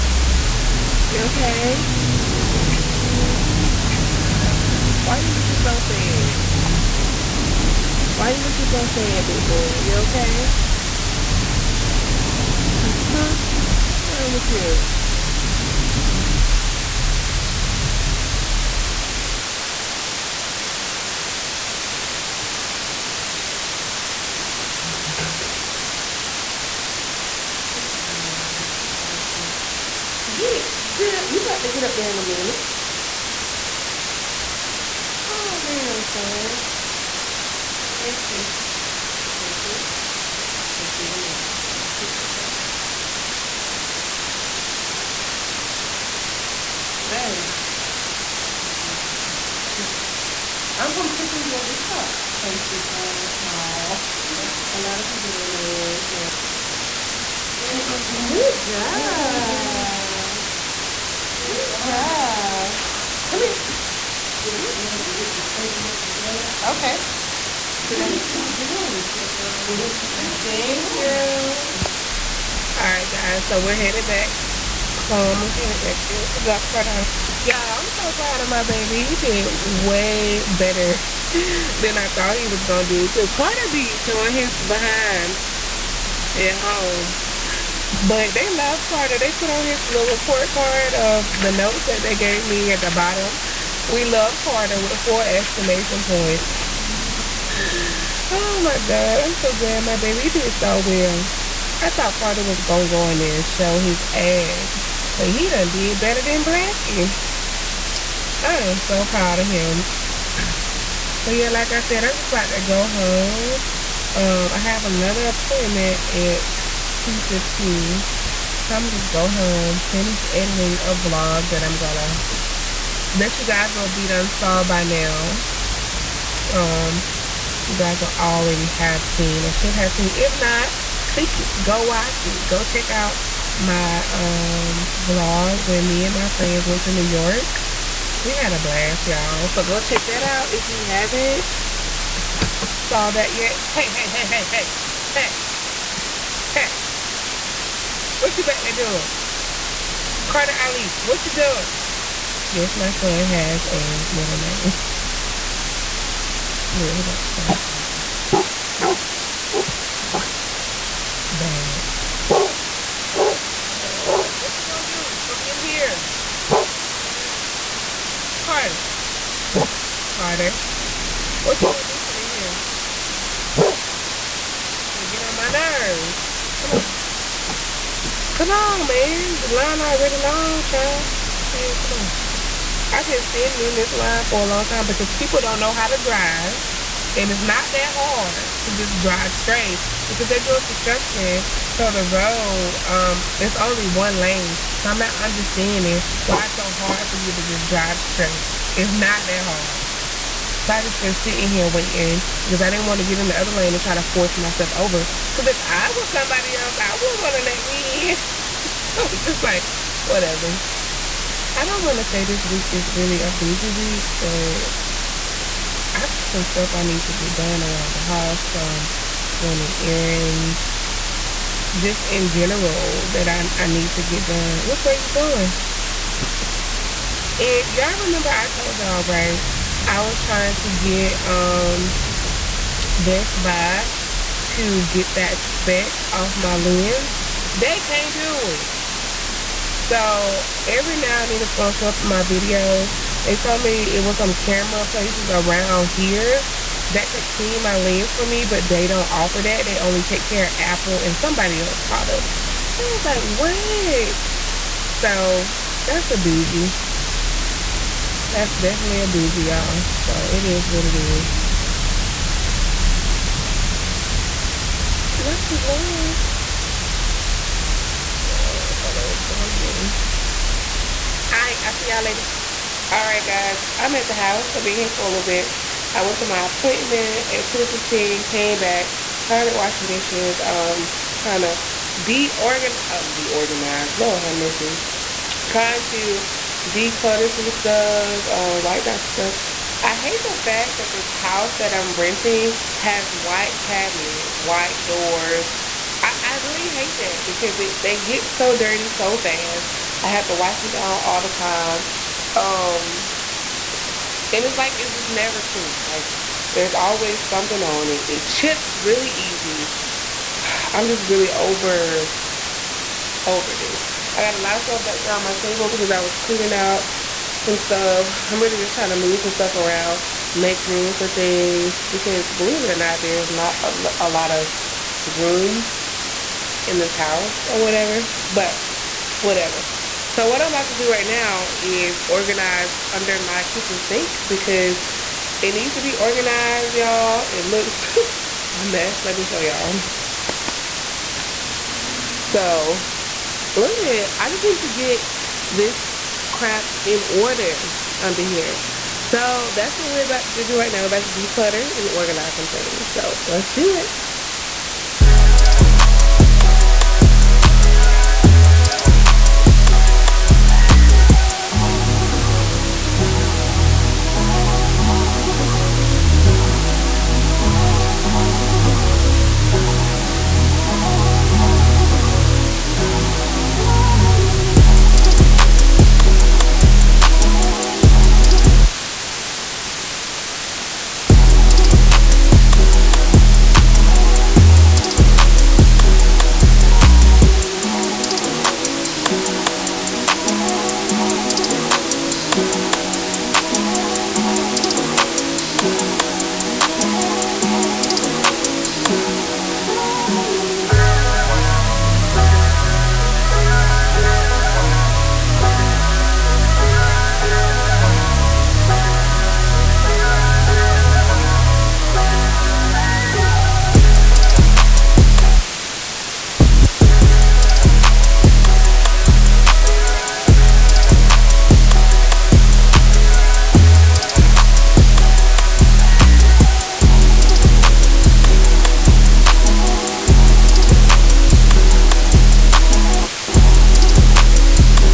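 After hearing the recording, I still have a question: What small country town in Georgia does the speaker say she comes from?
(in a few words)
Tifton.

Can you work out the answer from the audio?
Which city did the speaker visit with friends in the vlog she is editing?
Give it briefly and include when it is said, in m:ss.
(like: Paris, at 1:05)
New York, at 2:16.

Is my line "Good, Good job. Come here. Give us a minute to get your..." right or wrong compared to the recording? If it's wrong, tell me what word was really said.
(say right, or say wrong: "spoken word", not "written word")
right.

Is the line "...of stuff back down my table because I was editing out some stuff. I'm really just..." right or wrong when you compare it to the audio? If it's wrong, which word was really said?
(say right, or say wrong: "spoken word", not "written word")
wrong: "cleaning", not "editing".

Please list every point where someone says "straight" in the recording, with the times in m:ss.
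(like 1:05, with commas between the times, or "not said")
3:09, 3:18.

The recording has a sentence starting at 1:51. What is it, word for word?
But yeah, like I said, I'm just about to go home.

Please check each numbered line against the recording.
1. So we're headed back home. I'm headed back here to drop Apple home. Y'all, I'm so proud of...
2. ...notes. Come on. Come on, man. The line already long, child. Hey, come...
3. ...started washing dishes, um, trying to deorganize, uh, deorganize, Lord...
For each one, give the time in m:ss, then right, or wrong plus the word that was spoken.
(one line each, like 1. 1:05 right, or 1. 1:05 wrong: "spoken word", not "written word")
1. 1:13 wrong: "Carter", not "Apple"
2. 2:55 wrong: "nerves", not "notes"
3. 4:39 right.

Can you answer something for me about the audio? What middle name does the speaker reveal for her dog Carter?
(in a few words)
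Ali.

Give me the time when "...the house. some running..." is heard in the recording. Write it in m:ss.
3:37.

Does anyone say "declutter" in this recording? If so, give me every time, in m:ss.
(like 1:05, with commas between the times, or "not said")
4:46, 5:51.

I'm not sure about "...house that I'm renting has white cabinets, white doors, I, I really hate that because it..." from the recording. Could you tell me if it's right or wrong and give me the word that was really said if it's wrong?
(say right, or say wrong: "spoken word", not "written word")
right.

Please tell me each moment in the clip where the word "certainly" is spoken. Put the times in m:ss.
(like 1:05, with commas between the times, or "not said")
not said.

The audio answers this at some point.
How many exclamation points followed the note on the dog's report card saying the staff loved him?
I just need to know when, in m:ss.
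1:34.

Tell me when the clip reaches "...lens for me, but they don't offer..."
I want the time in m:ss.
4:07.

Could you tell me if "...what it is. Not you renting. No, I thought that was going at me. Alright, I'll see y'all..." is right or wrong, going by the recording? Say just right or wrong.
wrong.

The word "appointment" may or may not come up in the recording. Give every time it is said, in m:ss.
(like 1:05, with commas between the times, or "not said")
1:55, 4:36.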